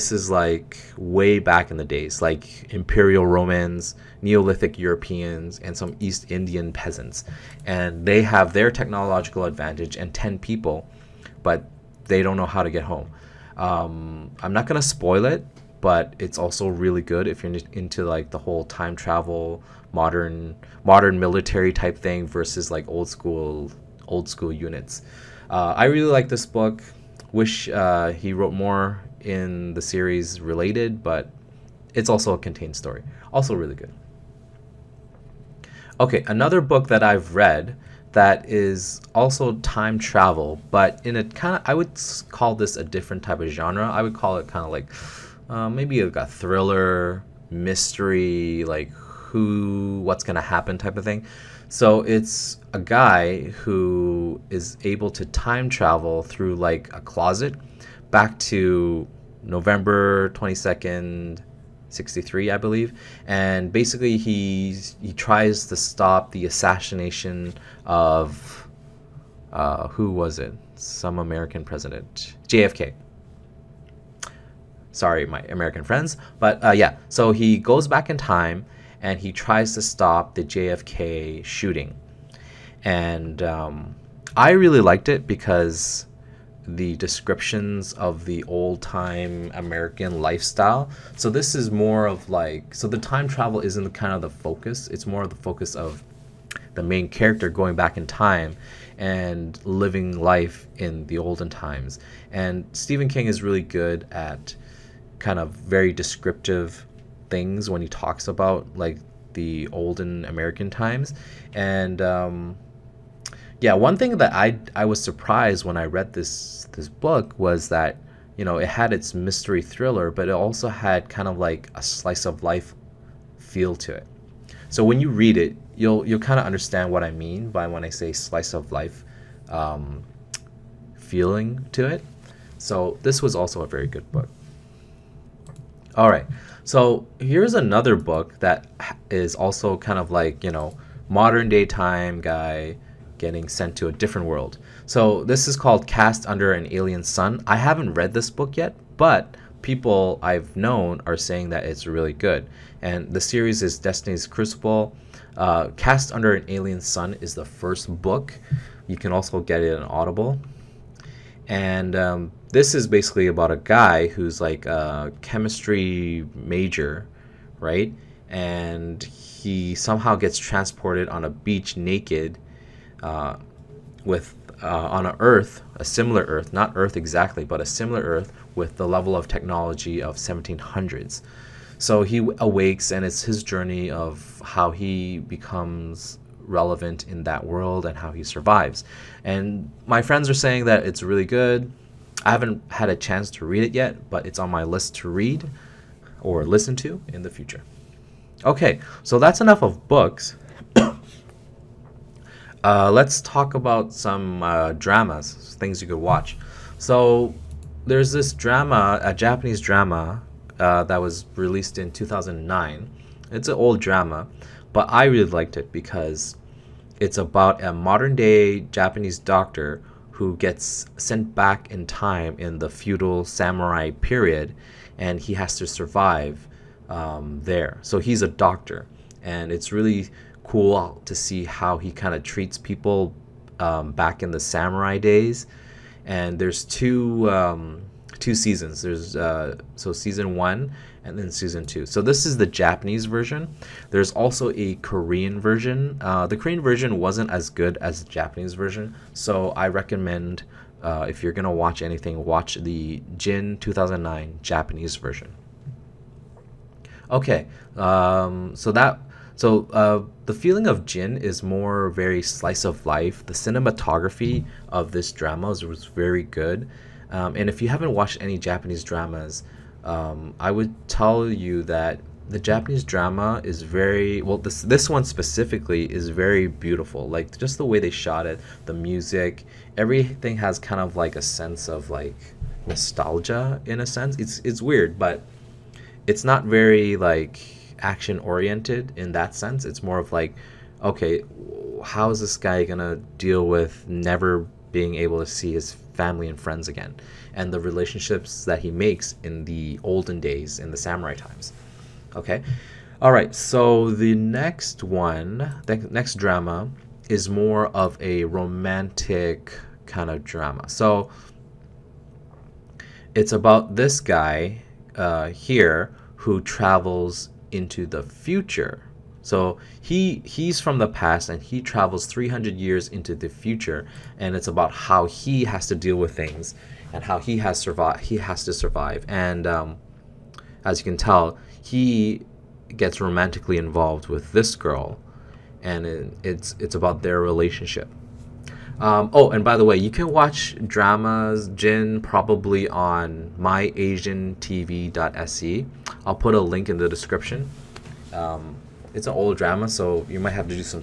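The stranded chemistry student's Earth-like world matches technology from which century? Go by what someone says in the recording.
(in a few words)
1700s.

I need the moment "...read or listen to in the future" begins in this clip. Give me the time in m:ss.
3:15.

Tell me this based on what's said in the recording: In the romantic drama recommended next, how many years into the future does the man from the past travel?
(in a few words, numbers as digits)
300 years.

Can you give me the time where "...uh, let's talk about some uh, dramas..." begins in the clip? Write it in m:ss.
3:22.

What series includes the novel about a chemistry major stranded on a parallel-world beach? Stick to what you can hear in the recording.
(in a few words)
Destiny's Crucible.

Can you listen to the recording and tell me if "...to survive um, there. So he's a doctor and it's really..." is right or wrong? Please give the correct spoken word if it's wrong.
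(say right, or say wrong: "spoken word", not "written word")
right.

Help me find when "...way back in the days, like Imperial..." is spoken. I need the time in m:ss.
0:00.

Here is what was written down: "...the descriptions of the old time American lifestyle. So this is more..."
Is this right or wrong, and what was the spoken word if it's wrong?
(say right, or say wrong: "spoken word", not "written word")
right.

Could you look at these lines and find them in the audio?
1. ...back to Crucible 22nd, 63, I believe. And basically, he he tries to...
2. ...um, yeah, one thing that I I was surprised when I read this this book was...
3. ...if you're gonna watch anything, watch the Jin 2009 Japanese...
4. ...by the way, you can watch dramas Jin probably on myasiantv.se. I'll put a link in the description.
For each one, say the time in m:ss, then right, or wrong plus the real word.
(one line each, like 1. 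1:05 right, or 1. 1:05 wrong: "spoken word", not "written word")
1. 0:58 wrong: "November", not "Crucible"
2. 1:52 right
3. 4:11 right
4. 5:39 right.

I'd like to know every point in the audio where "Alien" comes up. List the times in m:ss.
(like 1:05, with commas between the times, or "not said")
2:26, 2:36.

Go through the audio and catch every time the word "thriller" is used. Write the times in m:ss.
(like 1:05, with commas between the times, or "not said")
0:46, 1:59.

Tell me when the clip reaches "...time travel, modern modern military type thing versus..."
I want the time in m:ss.
0:18.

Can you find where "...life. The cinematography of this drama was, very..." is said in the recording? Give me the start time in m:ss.
4:22.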